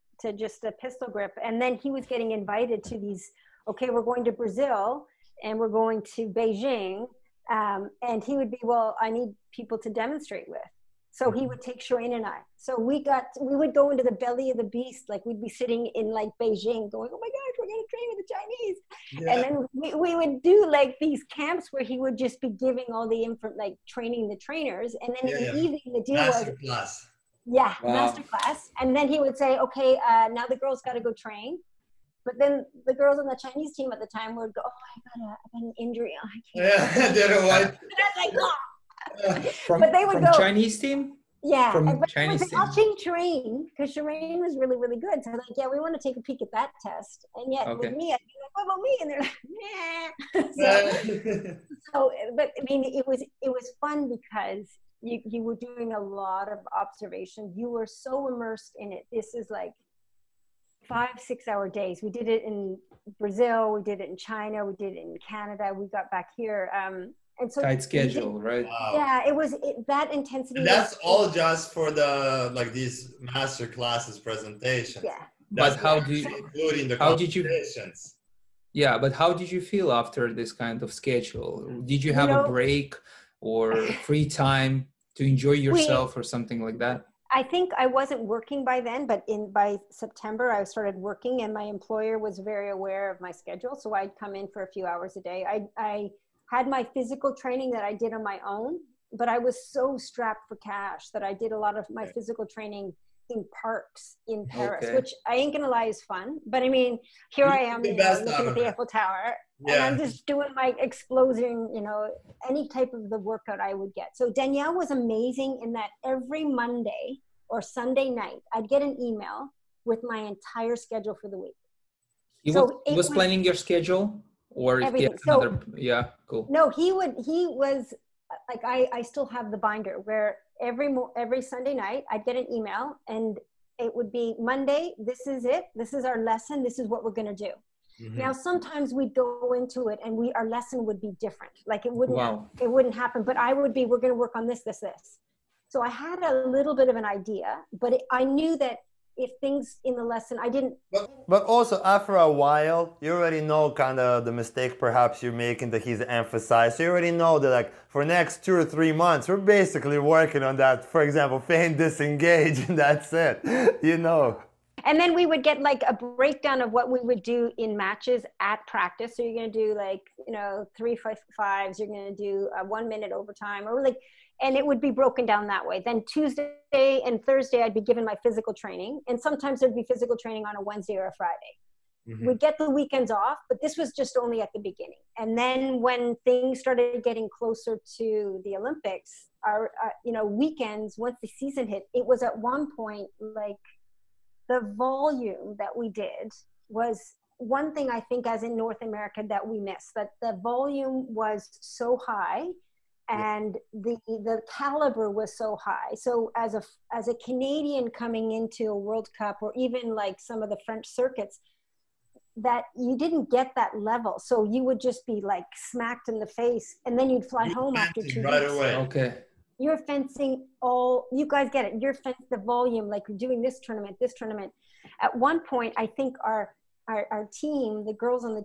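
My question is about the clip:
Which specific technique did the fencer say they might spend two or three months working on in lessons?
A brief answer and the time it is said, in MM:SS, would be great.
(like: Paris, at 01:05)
Feint disengage, at 02:41.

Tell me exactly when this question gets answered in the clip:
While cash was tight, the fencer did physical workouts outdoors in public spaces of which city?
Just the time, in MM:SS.
01:44.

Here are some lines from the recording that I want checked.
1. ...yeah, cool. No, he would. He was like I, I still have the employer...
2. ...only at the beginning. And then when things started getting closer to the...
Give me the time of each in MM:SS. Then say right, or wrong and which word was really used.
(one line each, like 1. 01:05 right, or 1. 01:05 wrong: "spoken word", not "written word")
1. 02:05 wrong: "binder", not "employer"
2. 03:04 right.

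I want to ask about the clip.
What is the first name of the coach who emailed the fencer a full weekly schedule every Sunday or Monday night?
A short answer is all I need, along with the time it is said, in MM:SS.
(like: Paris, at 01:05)
Daniel, at 01:54.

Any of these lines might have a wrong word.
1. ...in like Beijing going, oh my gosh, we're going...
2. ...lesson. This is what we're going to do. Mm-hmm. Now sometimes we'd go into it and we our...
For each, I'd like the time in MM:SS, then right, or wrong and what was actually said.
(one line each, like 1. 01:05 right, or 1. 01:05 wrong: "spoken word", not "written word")
1. 00:15 right
2. 02:16 right.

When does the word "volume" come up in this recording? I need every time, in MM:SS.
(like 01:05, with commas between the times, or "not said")
03:14, 03:20, 03:42.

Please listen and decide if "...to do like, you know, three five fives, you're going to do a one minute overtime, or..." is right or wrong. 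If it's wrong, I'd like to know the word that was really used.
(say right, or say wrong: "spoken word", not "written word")
right.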